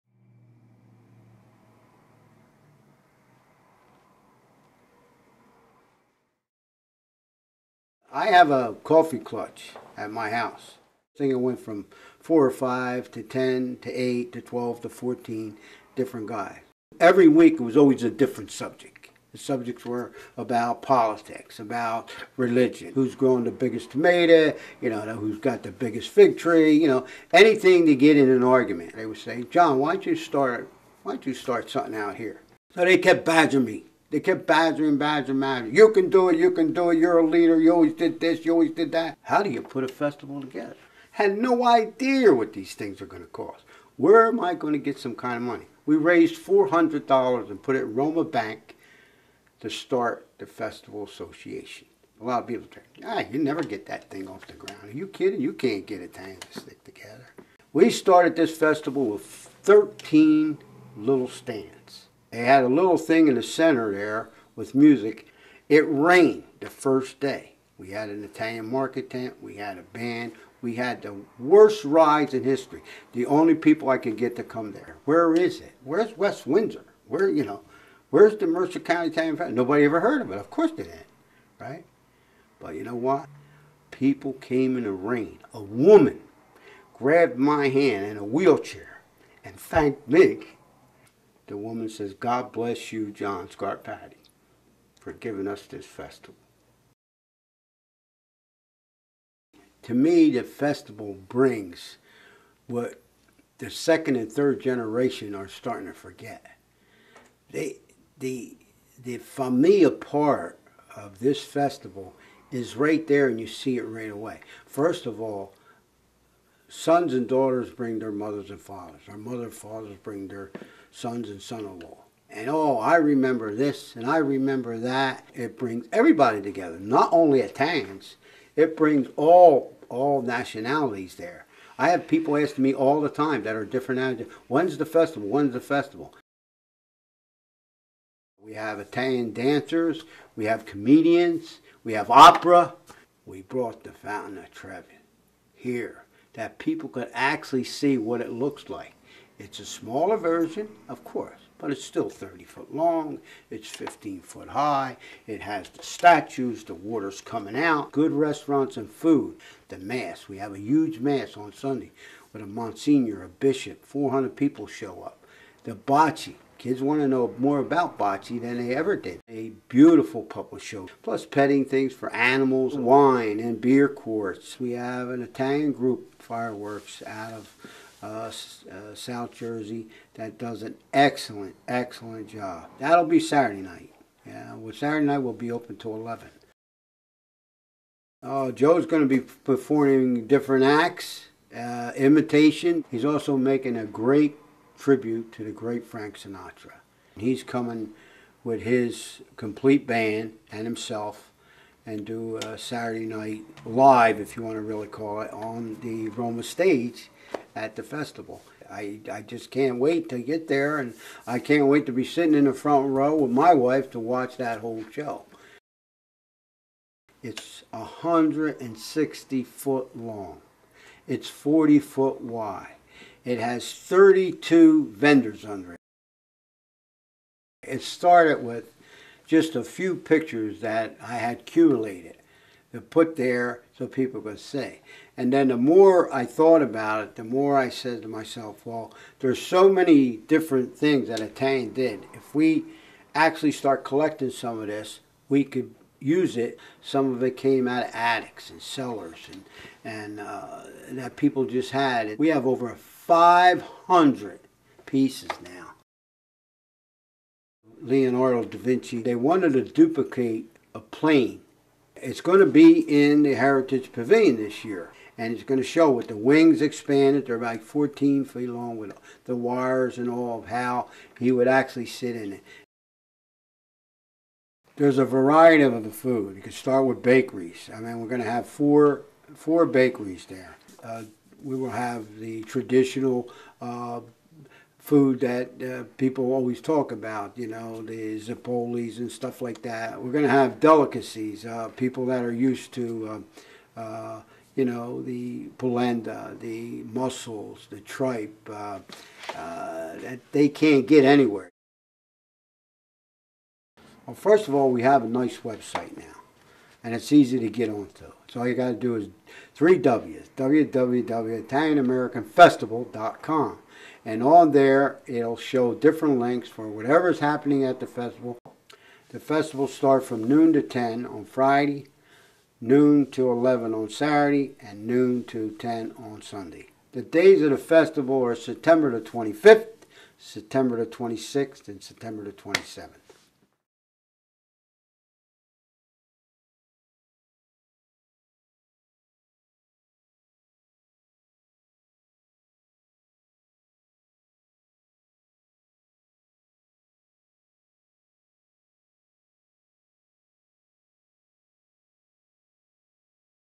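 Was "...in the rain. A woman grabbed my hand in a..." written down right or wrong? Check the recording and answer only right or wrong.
right.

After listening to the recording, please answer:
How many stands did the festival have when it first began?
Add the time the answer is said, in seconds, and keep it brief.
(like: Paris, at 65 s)
13, at 59 s.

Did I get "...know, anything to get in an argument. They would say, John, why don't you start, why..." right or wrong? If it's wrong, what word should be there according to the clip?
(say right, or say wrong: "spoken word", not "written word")
right.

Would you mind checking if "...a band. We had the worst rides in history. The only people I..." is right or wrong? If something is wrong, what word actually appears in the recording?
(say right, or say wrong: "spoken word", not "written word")
right.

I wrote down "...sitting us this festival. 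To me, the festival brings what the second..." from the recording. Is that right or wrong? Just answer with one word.
wrong.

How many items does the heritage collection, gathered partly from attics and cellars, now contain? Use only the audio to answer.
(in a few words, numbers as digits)
over 500.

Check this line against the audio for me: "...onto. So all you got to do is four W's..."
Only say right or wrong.
wrong.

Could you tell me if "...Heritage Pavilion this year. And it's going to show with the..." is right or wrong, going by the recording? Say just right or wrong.
right.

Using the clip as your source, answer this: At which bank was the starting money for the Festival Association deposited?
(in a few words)
Roma Bank.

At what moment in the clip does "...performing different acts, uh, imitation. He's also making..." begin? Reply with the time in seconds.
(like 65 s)
189 s.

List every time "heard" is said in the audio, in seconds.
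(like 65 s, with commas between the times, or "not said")
79 s.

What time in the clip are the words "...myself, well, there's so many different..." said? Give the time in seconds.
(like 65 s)
238 s.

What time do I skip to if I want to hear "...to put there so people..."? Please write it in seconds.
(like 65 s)
232 s.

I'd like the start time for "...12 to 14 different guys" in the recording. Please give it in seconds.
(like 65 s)
14 s.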